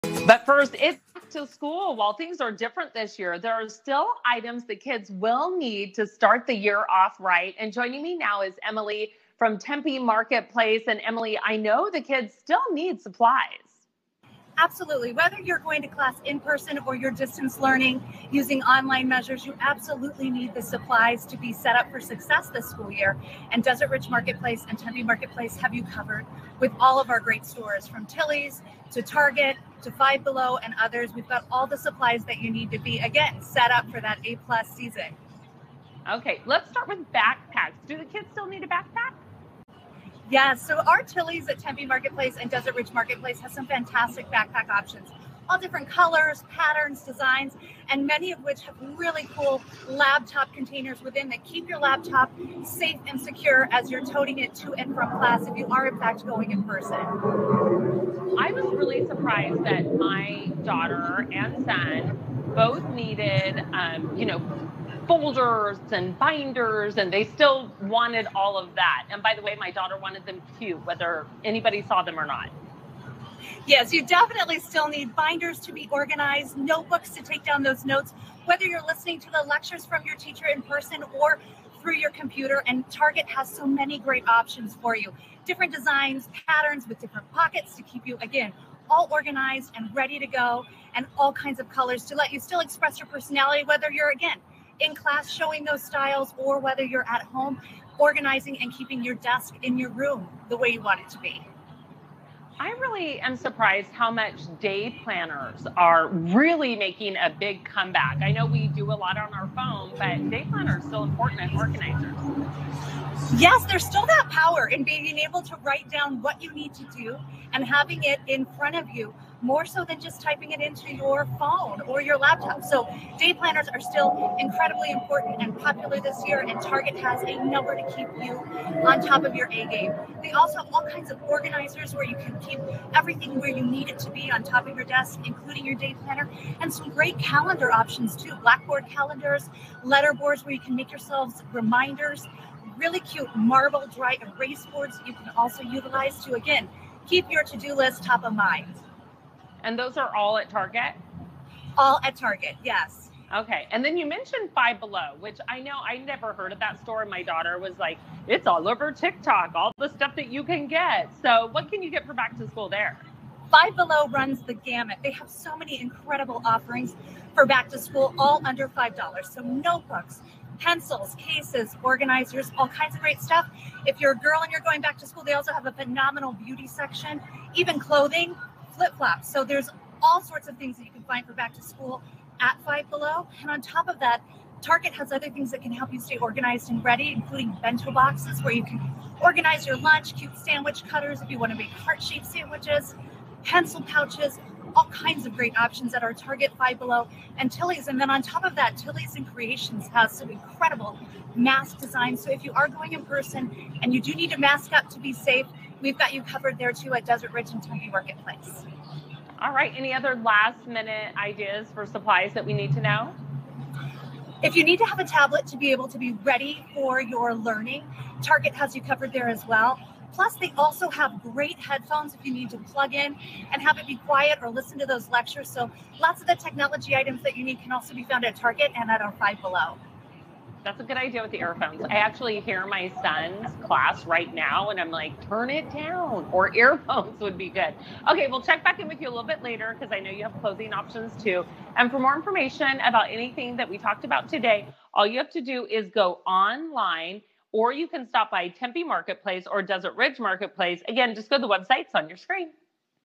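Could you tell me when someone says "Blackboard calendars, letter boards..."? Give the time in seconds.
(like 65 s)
138 s.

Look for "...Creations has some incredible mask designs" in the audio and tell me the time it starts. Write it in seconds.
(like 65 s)
199 s.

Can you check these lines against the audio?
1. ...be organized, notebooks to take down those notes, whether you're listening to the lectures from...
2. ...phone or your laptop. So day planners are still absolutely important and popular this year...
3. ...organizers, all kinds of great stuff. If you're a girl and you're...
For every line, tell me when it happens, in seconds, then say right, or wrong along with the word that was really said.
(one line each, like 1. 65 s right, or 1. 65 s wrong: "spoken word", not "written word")
1. 75 s right
2. 121 s wrong: "incredibly", not "absolutely"
3. 171 s right.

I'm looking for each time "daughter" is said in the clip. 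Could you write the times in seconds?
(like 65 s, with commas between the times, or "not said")
60 s, 69 s, 157 s.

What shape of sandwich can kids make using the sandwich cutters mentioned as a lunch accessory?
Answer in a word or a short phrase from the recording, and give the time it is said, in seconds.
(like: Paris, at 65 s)
Heart, at 191 s.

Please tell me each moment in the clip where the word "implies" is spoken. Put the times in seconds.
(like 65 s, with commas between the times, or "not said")
not said.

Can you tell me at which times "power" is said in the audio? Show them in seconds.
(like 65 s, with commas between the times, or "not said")
114 s.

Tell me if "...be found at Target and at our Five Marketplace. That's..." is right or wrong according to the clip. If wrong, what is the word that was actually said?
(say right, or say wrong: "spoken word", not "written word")
wrong: "Below", not "Marketplace".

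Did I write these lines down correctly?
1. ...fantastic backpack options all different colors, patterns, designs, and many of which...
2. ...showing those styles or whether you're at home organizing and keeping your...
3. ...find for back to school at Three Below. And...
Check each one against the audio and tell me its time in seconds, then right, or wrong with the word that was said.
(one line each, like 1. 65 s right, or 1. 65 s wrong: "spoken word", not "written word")
1. 43 s right
2. 95 s right
3. 181 s wrong: "Five", not "Three".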